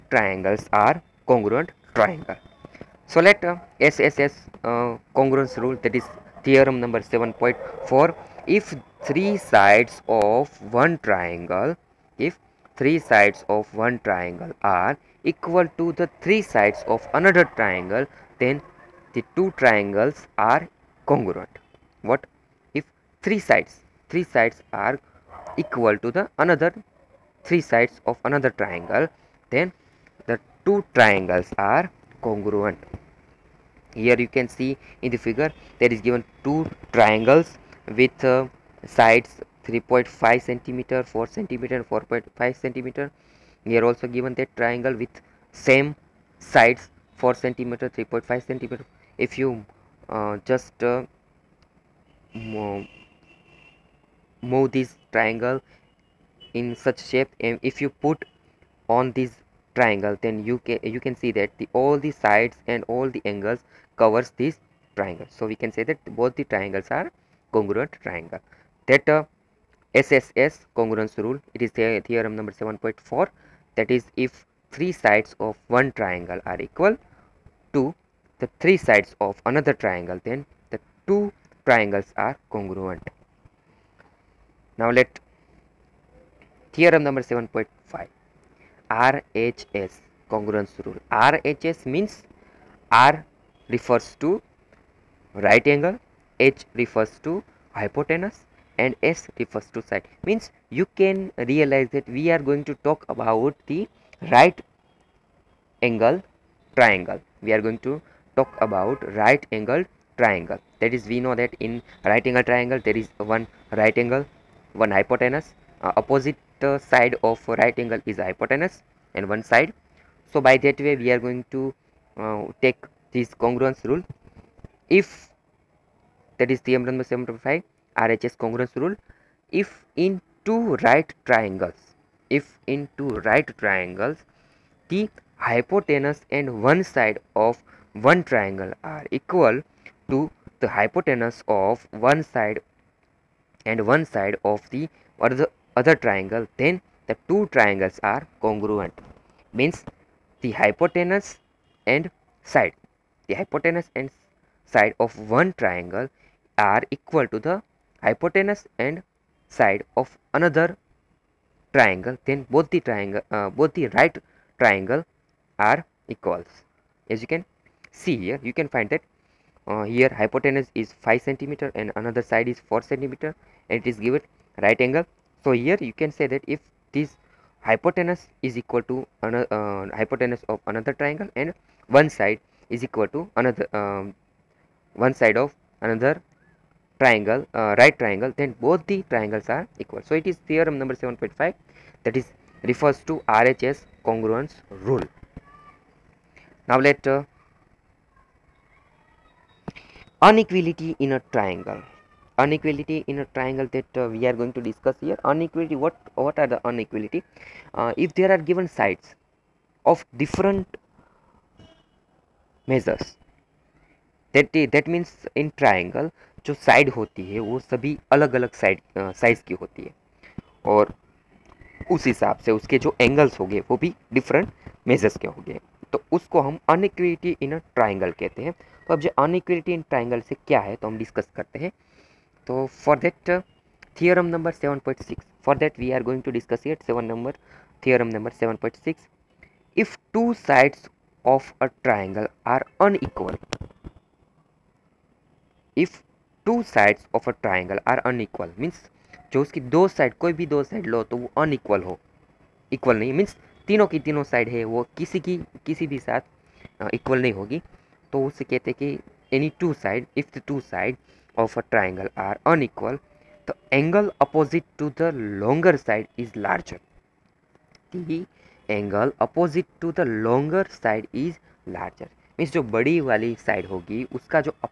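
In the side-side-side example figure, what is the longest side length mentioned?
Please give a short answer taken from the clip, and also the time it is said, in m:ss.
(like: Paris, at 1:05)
4.5 centimeter, at 0:41.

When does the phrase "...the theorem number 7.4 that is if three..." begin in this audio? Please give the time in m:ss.
1:11.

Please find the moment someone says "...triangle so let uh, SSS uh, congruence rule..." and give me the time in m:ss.
0:01.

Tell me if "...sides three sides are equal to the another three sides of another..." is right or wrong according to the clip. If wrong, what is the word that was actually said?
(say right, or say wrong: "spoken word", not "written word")
right.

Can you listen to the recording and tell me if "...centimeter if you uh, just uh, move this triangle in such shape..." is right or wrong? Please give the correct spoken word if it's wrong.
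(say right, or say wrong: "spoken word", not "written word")
right.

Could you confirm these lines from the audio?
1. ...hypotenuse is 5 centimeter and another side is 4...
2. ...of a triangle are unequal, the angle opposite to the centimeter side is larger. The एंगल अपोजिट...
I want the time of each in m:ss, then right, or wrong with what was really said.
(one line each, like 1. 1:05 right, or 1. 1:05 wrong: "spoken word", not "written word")
1. 2:50 right
2. 4:21 wrong: "longer", not "centimeter".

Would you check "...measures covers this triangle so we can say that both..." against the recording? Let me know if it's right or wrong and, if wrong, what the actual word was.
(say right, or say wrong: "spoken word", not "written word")
wrong: "angles", not "measures".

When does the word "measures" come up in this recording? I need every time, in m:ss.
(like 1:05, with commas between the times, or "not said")
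3:32.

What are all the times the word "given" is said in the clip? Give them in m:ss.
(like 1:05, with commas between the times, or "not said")
0:36, 0:44, 2:54, 3:28.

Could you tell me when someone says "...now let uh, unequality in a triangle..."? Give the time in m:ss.
3:16.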